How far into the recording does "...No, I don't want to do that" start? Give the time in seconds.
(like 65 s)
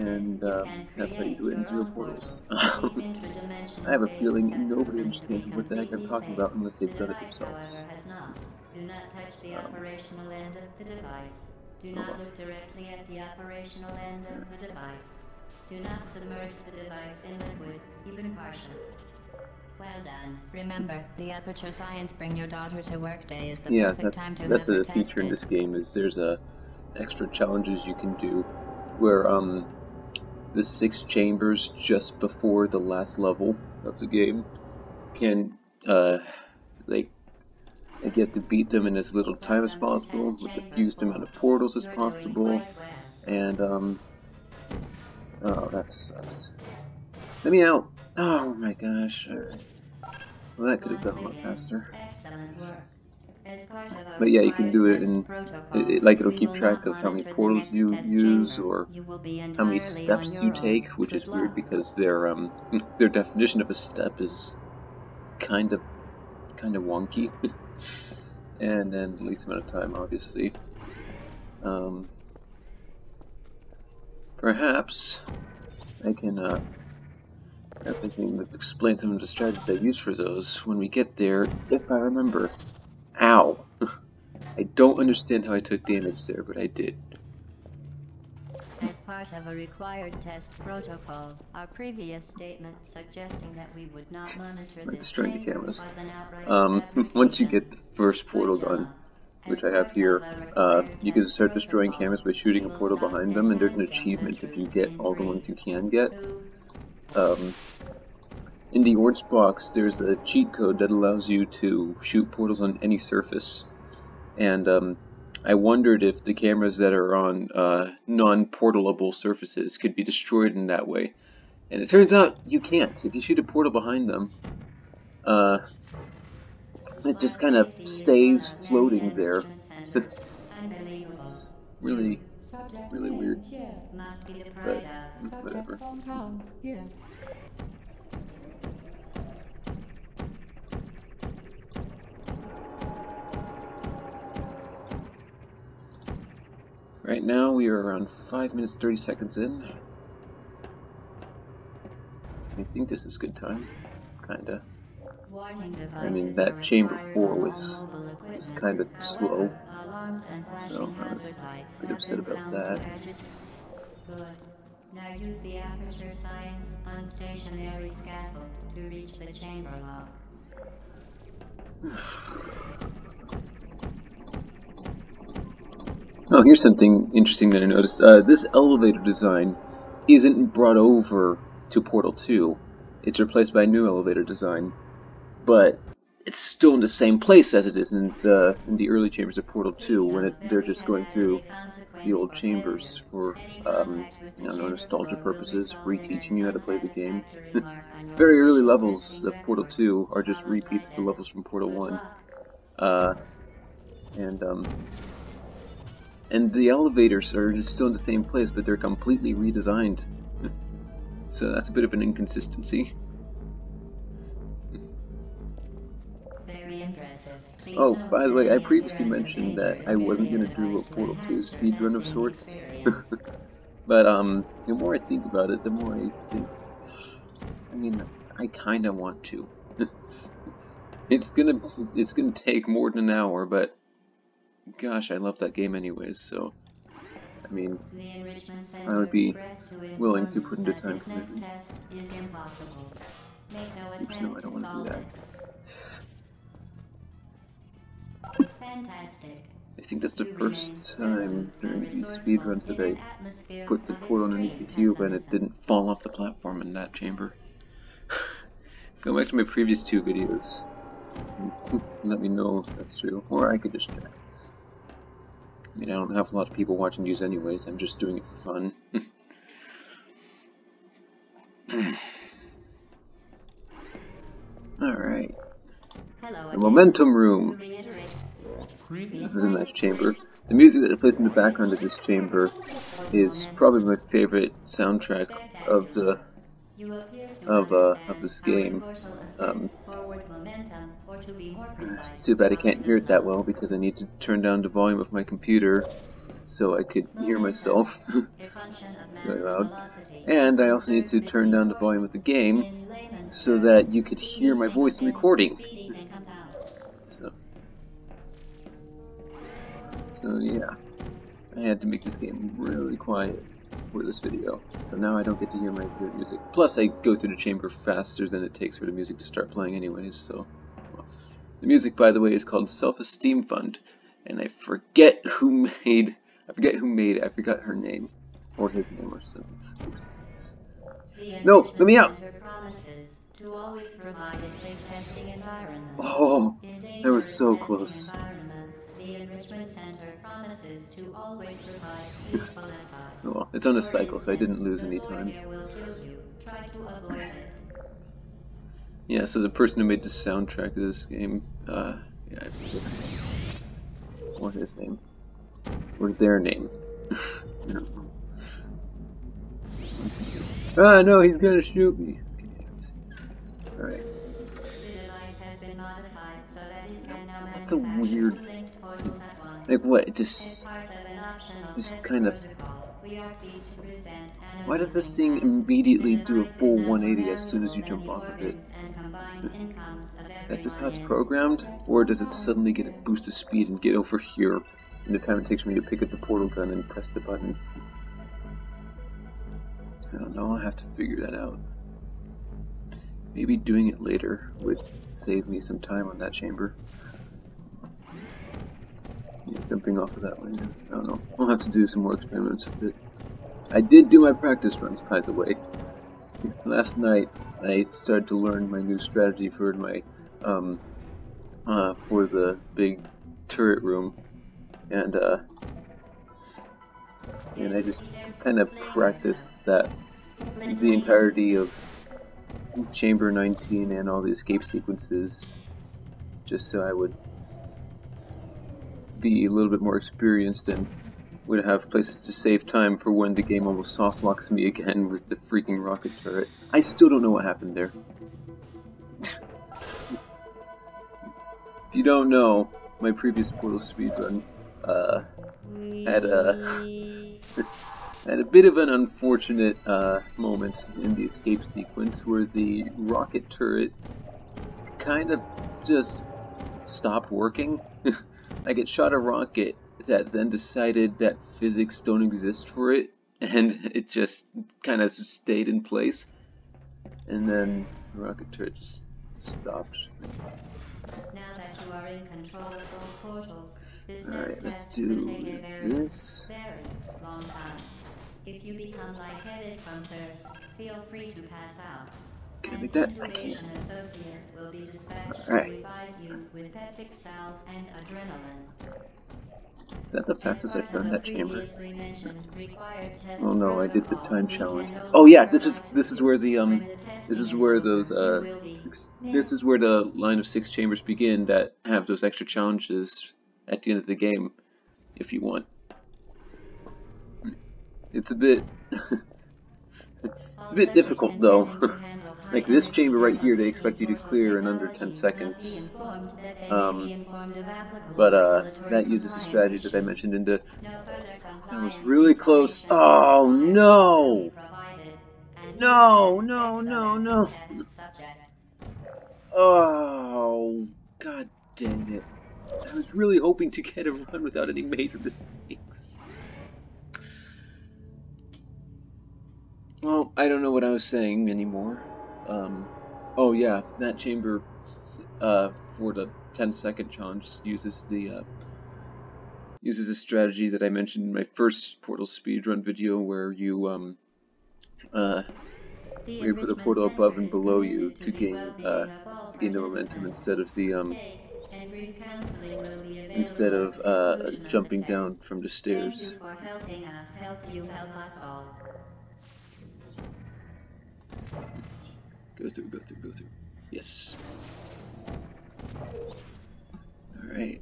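241 s.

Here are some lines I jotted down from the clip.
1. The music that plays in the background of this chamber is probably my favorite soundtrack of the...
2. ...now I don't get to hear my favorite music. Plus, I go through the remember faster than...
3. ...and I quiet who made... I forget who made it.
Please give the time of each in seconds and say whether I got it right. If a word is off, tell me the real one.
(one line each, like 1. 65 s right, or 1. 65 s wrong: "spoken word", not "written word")
1. 280 s right
2. 314 s wrong: "chamber", not "remember"
3. 324 s wrong: "forget", not "quiet".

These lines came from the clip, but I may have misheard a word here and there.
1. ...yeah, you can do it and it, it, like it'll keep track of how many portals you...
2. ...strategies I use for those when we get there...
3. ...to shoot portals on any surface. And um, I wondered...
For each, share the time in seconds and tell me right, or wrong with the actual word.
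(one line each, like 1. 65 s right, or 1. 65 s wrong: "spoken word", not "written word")
1. 54 s right
2. 79 s right
3. 111 s right.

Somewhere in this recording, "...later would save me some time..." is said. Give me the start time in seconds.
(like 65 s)
394 s.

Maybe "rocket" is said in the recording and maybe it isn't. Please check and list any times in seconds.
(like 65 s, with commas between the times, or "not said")
435 s, 452 s, 459 s, 468 s.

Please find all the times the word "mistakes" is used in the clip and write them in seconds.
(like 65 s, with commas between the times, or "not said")
535 s.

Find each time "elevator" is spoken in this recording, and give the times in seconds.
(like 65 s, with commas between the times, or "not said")
178 s, 183 s, 206 s.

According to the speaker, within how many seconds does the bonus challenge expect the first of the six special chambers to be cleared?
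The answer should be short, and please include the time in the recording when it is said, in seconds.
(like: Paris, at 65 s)
10 seconds, at 514 s.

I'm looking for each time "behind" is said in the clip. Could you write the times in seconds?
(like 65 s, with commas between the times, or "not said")
102 s, 123 s.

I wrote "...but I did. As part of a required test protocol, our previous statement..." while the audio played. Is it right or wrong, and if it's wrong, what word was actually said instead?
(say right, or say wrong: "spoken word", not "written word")
right.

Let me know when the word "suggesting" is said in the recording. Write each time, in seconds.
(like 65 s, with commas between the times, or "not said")
92 s.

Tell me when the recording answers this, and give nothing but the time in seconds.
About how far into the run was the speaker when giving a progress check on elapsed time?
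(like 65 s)
148 s.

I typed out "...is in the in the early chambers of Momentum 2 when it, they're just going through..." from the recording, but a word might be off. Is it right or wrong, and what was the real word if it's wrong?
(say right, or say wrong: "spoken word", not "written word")
wrong: "Portal", not "Momentum".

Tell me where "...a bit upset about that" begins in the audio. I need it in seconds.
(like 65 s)
161 s.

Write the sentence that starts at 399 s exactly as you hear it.
Yeah, jumping off of that one, yeah.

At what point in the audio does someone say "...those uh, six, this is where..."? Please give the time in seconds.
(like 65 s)
497 s.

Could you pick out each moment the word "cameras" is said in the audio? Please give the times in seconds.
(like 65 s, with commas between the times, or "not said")
95 s, 101 s, 116 s.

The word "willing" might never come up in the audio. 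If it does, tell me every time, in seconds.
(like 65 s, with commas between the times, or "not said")
239 s.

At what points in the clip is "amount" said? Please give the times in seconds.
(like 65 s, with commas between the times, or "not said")
41 s, 69 s.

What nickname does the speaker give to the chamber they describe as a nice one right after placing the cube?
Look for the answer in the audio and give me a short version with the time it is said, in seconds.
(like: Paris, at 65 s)
The Momentum Room, at 276 s.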